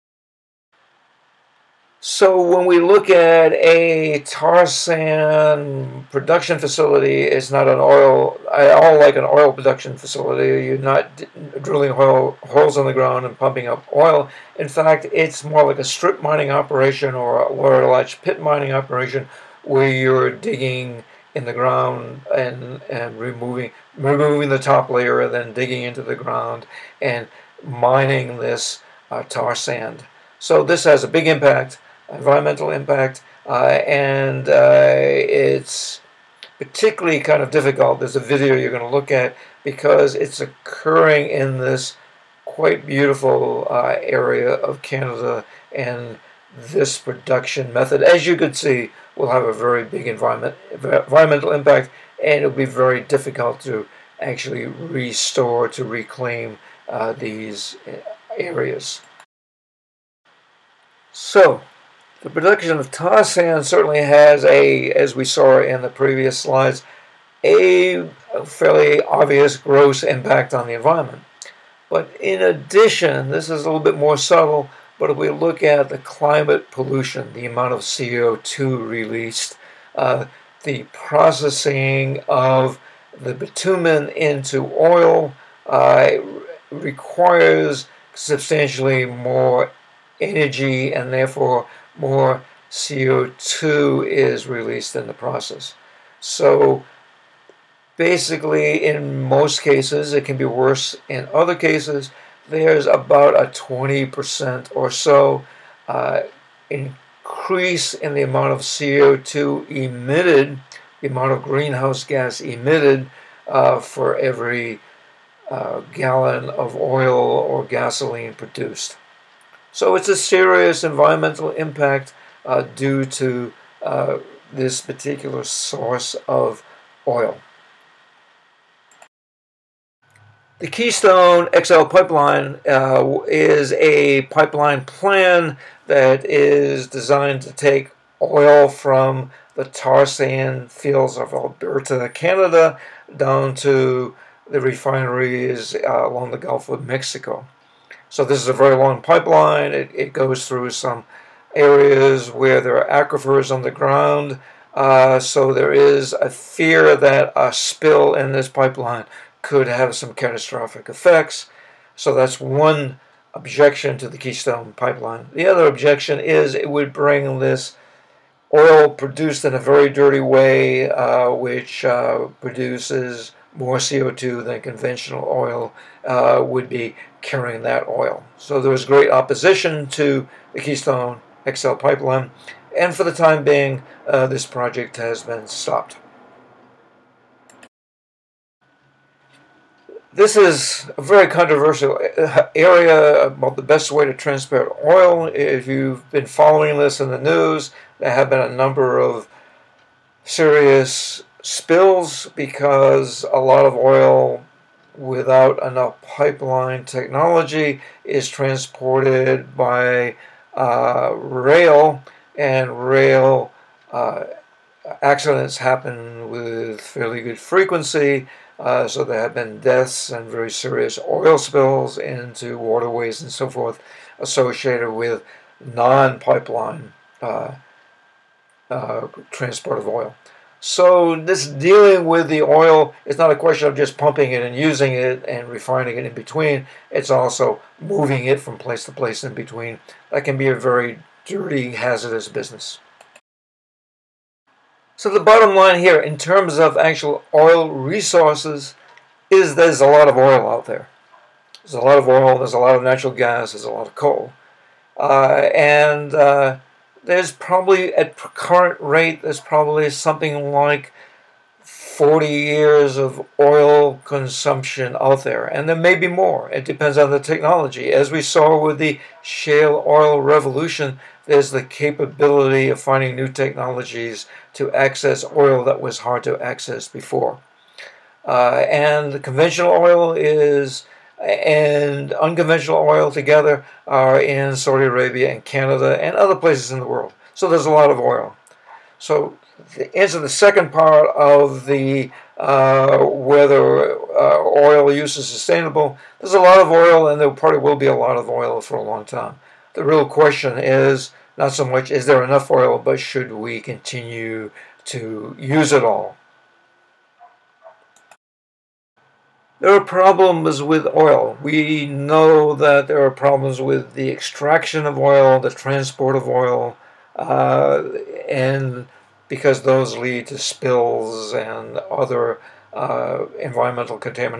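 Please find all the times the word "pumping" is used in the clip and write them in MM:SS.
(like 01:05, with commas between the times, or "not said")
00:13, 03:53.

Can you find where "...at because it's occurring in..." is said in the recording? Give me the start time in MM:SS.
00:39.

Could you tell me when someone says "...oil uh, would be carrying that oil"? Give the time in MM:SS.
02:55.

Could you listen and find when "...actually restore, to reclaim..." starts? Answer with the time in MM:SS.
00:54.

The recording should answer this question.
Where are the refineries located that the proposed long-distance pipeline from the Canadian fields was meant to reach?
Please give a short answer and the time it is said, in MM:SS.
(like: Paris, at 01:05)
Gulf of Mexico, at 02:26.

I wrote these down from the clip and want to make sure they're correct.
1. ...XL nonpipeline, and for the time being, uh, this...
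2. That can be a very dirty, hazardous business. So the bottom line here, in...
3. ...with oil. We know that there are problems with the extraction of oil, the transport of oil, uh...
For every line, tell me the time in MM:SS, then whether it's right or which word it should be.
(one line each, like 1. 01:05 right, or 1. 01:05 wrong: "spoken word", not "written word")
1. 03:01 wrong: "pipeline", not "nonpipeline"
2. 04:00 right
3. 05:10 right.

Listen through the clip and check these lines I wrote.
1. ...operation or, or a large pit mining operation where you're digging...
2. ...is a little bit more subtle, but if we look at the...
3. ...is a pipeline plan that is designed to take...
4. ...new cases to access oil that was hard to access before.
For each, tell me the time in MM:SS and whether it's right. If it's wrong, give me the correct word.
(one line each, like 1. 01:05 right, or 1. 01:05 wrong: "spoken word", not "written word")
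1. 00:16 right
2. 01:13 right
3. 02:13 right
4. 04:33 wrong: "technologies", not "cases".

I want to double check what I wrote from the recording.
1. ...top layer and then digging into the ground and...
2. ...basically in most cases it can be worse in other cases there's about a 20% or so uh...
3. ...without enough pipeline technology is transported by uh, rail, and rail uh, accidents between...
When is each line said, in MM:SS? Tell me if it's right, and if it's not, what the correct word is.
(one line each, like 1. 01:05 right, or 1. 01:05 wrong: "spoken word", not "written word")
1. 00:24 right
2. 01:37 right
3. 03:24 wrong: "happen", not "between".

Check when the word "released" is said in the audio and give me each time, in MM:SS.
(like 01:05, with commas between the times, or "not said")
01:18, 01:34.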